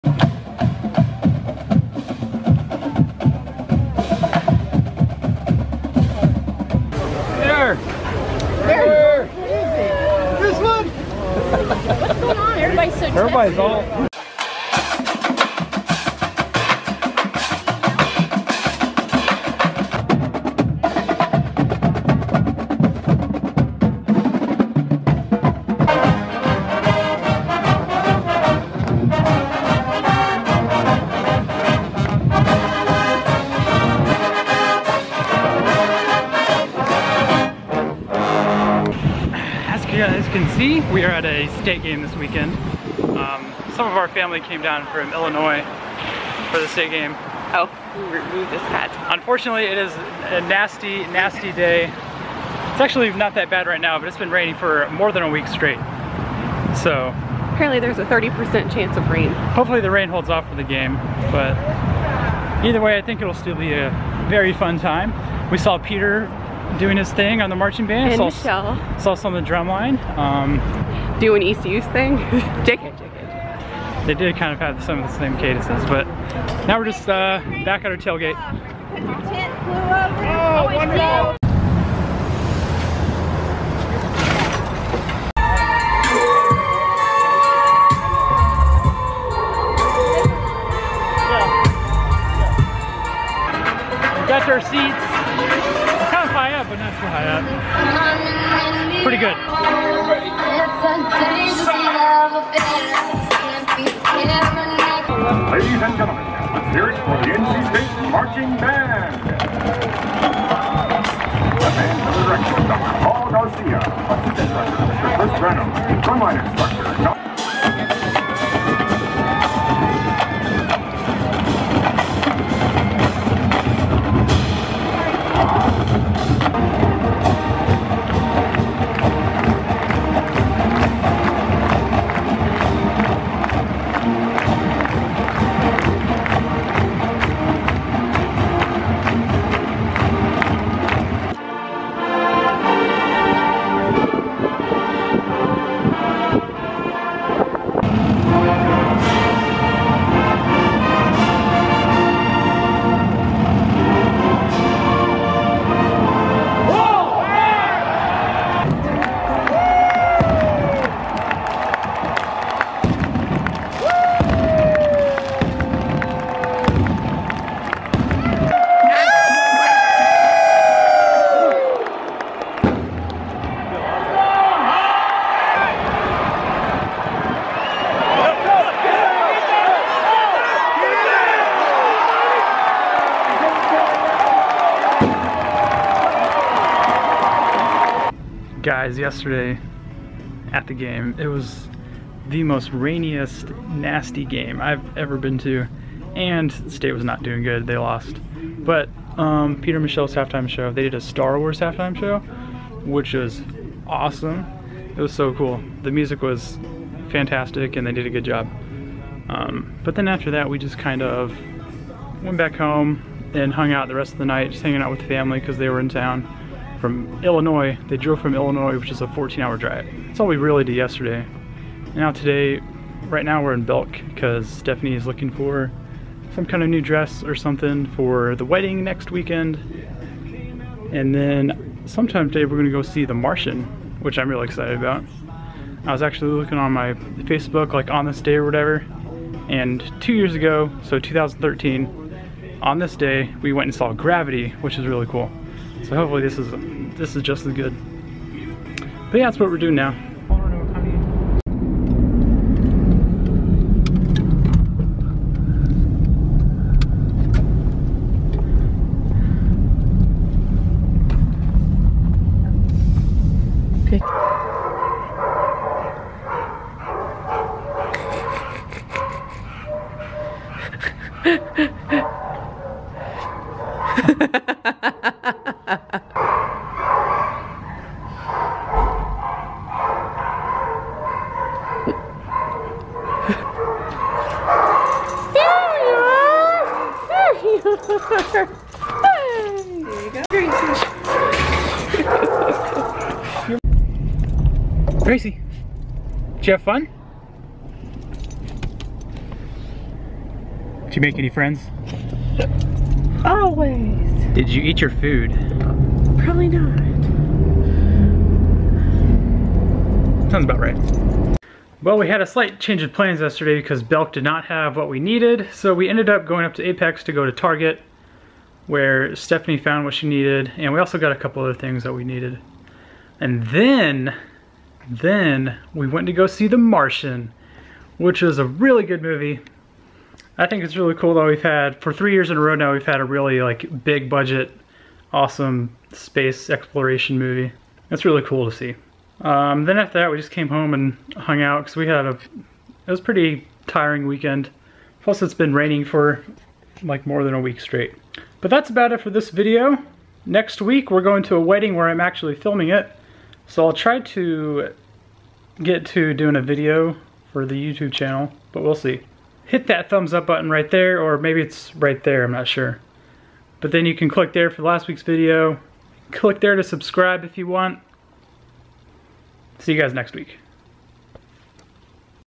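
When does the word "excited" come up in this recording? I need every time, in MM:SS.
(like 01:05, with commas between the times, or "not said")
03:54.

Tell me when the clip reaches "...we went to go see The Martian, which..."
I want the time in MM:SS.
05:25.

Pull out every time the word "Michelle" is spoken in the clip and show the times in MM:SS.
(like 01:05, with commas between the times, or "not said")
01:08, 03:19.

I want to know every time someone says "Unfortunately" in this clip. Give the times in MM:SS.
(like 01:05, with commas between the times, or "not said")
00:49.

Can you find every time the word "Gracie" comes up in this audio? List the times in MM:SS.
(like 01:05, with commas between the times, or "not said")
04:50, 04:55.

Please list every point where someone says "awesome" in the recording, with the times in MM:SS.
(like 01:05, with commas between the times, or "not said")
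03:23, 05:35.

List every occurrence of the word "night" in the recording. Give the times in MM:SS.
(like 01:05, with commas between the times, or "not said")
03:34.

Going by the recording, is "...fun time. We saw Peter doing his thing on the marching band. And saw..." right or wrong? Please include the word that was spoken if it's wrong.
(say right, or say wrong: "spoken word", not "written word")
right.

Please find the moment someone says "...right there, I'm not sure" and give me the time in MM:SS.
06:01.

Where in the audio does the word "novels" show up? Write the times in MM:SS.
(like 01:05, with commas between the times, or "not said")
not said.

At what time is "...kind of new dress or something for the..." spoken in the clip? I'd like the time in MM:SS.
03:46.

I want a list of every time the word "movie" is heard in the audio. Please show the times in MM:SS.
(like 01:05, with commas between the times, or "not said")
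05:29, 05:37.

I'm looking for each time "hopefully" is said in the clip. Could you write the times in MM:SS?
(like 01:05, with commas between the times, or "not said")
00:59, 04:05.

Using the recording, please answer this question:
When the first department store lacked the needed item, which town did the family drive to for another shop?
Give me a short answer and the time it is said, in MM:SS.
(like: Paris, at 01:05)
Apex, at 05:16.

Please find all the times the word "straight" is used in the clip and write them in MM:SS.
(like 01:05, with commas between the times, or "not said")
00:55, 05:47.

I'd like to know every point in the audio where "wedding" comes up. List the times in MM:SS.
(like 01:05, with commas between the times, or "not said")
03:48, 05:51.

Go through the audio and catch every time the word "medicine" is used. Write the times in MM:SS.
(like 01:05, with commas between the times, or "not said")
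not said.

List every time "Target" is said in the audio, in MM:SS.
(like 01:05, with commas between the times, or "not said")
05:17.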